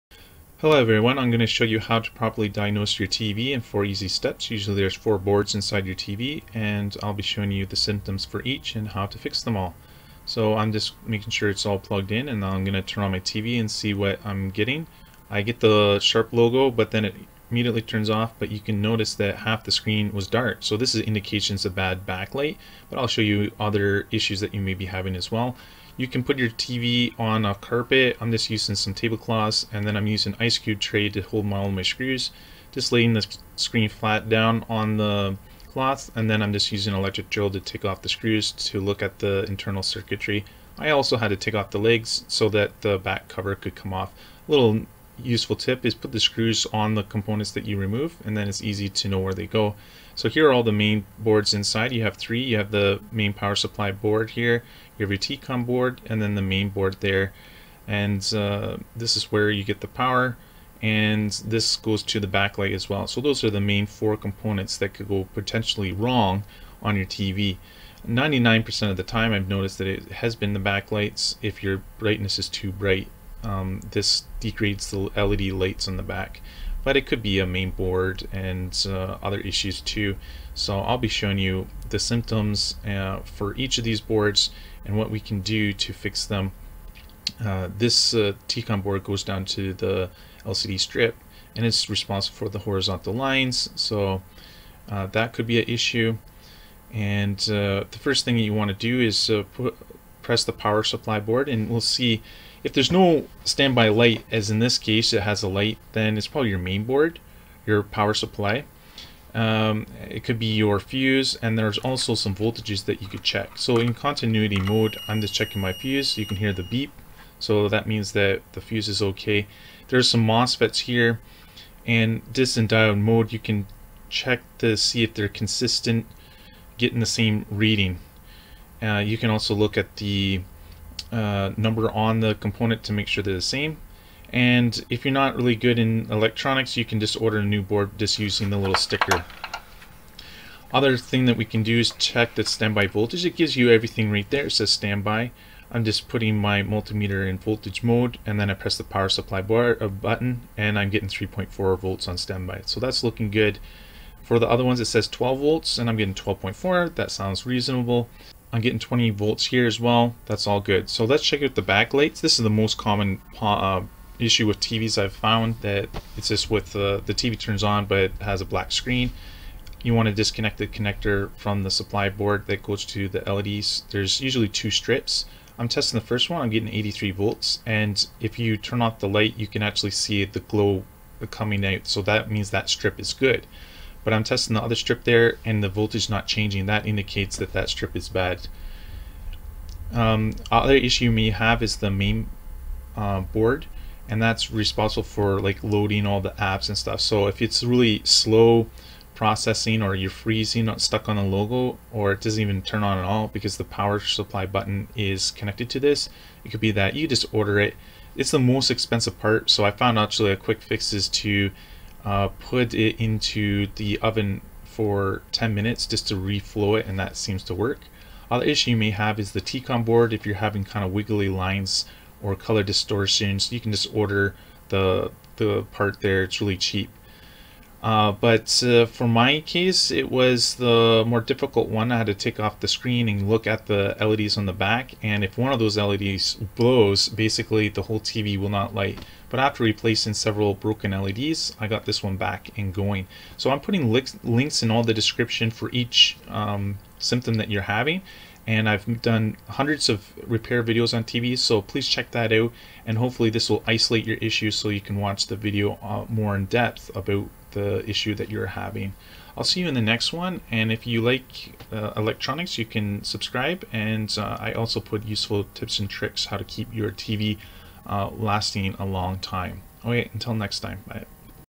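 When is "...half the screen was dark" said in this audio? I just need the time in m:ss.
0:19.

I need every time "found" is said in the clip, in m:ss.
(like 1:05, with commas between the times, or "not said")
2:45, 3:29.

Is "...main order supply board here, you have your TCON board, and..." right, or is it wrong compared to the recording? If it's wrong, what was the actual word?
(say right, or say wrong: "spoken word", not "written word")
wrong: "power", not "order".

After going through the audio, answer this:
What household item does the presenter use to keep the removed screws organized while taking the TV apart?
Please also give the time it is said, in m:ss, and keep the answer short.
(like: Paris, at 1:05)
Ice cube tray, at 0:30.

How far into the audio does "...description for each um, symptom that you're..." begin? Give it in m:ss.
4:04.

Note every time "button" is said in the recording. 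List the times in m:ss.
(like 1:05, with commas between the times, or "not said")
2:29, 3:24.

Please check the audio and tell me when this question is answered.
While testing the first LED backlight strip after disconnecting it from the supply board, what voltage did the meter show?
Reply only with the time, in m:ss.
2:56.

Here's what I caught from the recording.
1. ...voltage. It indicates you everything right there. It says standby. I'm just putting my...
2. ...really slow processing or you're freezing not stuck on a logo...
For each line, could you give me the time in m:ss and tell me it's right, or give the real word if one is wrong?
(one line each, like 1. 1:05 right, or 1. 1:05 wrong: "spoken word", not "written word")
1. 2:22 wrong: "gives", not "indicates"
2. 3:17 right.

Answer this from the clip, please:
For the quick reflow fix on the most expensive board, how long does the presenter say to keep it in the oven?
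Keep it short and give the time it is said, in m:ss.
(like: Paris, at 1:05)
10 minutes, at 3:35.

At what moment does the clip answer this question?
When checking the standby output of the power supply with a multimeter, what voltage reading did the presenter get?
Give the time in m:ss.
2:31.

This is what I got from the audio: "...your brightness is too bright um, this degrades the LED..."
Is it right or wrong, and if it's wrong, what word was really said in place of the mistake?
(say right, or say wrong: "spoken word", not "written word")
right.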